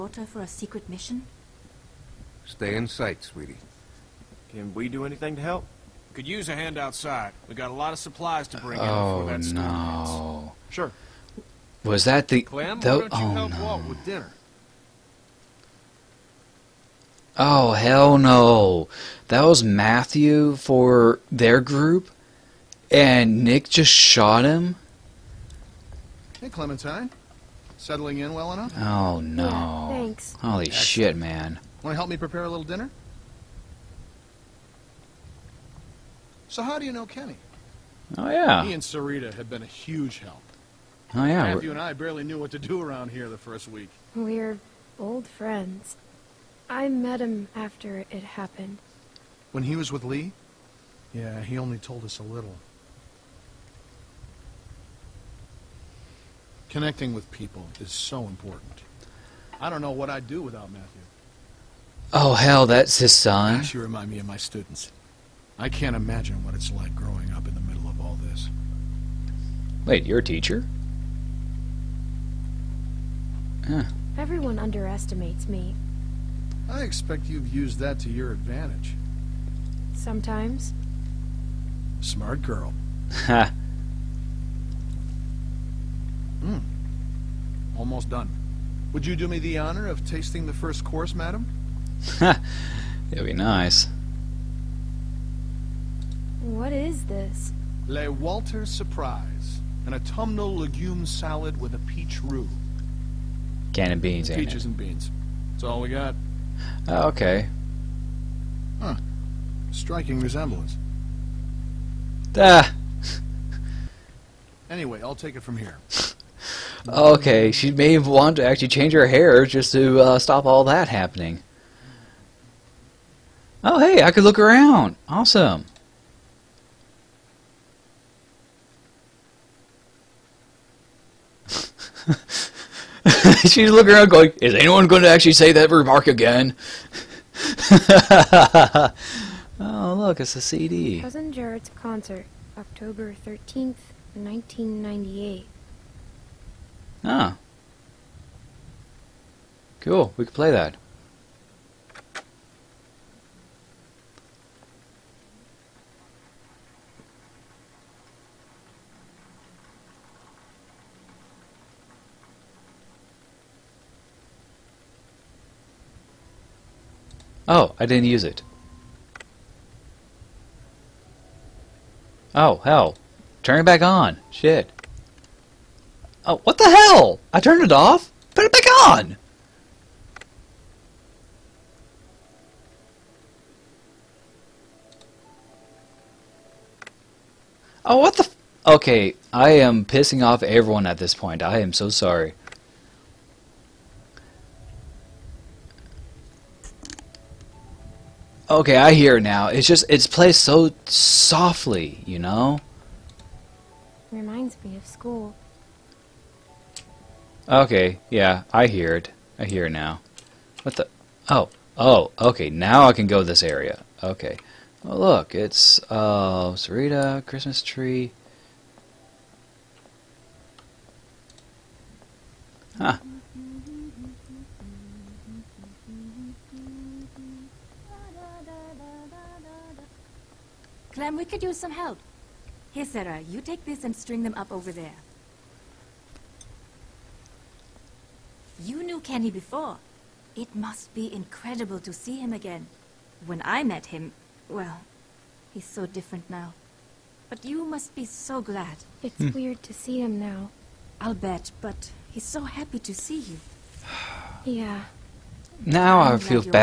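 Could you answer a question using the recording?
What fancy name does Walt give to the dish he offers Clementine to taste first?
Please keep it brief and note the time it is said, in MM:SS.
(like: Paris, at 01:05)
Le Walter Surprise, at 01:37.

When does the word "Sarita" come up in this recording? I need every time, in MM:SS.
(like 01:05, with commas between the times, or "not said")
00:38, 03:36.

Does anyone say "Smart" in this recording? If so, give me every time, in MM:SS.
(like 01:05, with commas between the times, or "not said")
01:22.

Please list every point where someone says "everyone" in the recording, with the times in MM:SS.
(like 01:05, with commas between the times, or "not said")
01:14, 03:10.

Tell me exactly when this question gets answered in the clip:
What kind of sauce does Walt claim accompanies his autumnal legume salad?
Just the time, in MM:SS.
01:41.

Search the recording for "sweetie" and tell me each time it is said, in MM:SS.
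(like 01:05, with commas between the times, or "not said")
00:03.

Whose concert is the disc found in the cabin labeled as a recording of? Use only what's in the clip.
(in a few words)
Cousin Jared.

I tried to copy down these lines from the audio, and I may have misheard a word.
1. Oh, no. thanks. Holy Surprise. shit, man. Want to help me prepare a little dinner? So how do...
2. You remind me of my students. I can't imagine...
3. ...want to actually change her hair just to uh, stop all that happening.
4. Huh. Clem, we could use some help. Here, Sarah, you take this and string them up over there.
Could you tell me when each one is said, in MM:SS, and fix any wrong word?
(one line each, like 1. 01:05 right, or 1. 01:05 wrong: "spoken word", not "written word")
1. 00:28 wrong: "Excellent", not "Surprise"
2. 01:03 right
3. 01:57 right
4. 03:42 right.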